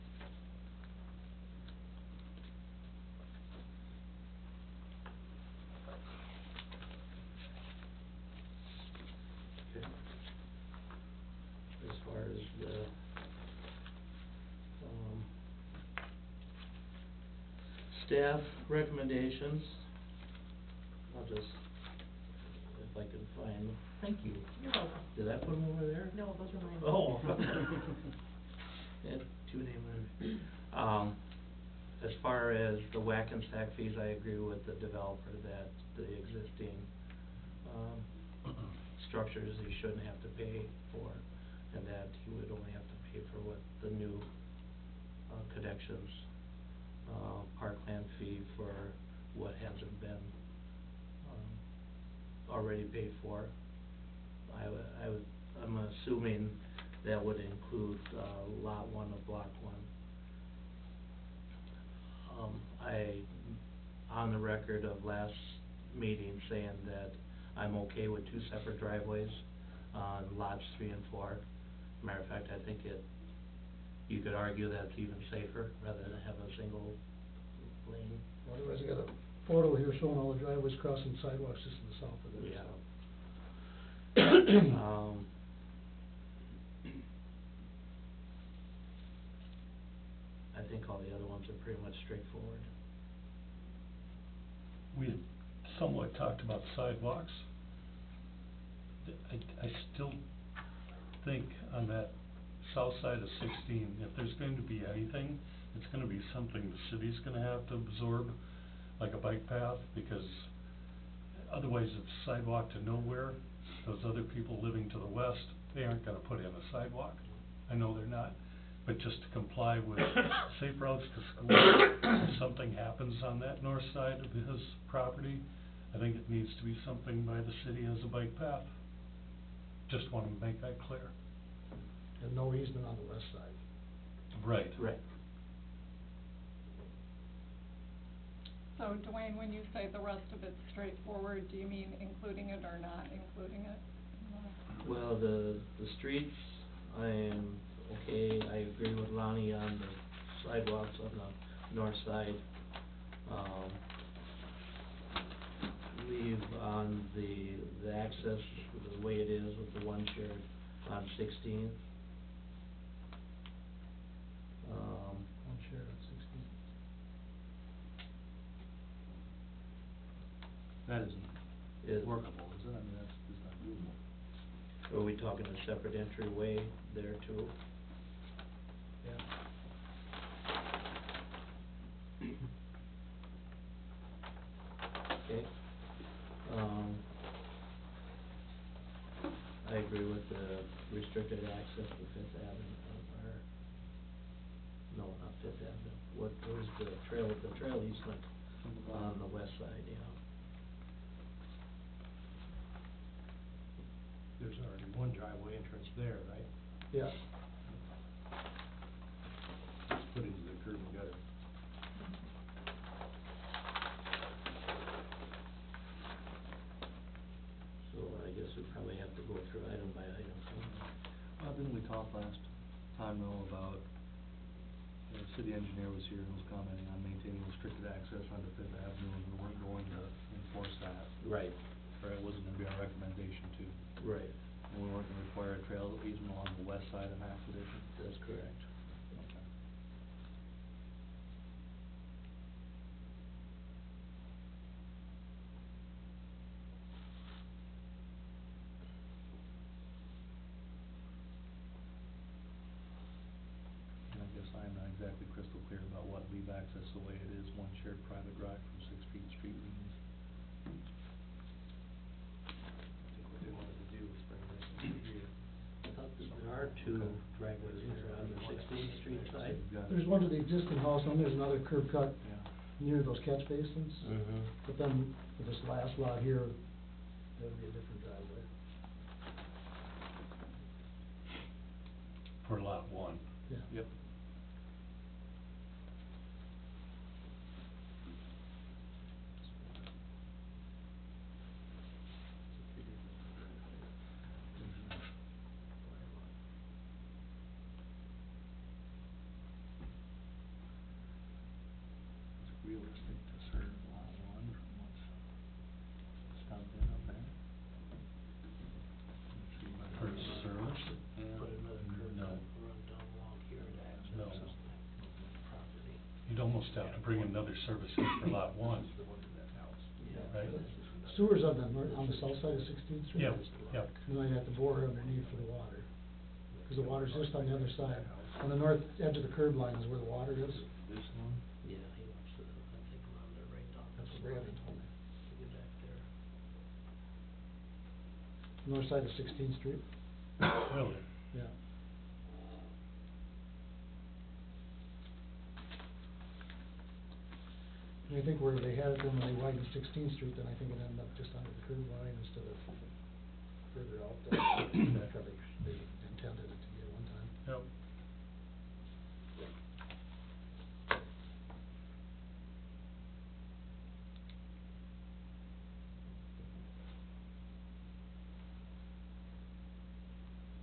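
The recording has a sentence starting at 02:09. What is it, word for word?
Just wanna make that clear and no easement on the west side.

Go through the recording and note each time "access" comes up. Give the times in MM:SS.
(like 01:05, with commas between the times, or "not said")
02:37, 03:11, 03:47.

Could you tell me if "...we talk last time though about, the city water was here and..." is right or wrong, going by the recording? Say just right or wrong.
wrong.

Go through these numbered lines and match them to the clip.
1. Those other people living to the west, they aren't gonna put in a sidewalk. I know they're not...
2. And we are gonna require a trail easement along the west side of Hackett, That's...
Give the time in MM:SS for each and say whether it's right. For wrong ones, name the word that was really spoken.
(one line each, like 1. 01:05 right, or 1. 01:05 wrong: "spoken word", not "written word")
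1. 01:53 right
2. 03:54 right.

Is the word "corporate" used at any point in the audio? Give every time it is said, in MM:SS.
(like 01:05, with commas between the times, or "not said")
not said.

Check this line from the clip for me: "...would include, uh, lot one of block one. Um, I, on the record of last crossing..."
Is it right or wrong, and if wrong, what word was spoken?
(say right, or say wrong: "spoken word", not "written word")
wrong: "meeting", not "crossing".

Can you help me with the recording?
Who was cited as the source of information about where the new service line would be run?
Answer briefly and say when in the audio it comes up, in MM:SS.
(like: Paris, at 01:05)
Brandon, at 05:34.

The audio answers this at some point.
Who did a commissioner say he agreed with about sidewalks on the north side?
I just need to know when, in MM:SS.
02:29.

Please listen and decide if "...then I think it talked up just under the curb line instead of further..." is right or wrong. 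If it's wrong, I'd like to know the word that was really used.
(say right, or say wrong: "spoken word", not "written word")
wrong: "ended", not "talked".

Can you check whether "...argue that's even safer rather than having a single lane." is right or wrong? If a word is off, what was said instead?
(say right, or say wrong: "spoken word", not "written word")
right.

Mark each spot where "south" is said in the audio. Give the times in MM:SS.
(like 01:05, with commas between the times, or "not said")
01:22, 01:42, 05:22.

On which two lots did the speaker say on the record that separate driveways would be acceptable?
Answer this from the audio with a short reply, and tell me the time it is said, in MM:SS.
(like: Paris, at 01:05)
Lots 3 and 4, at 01:10.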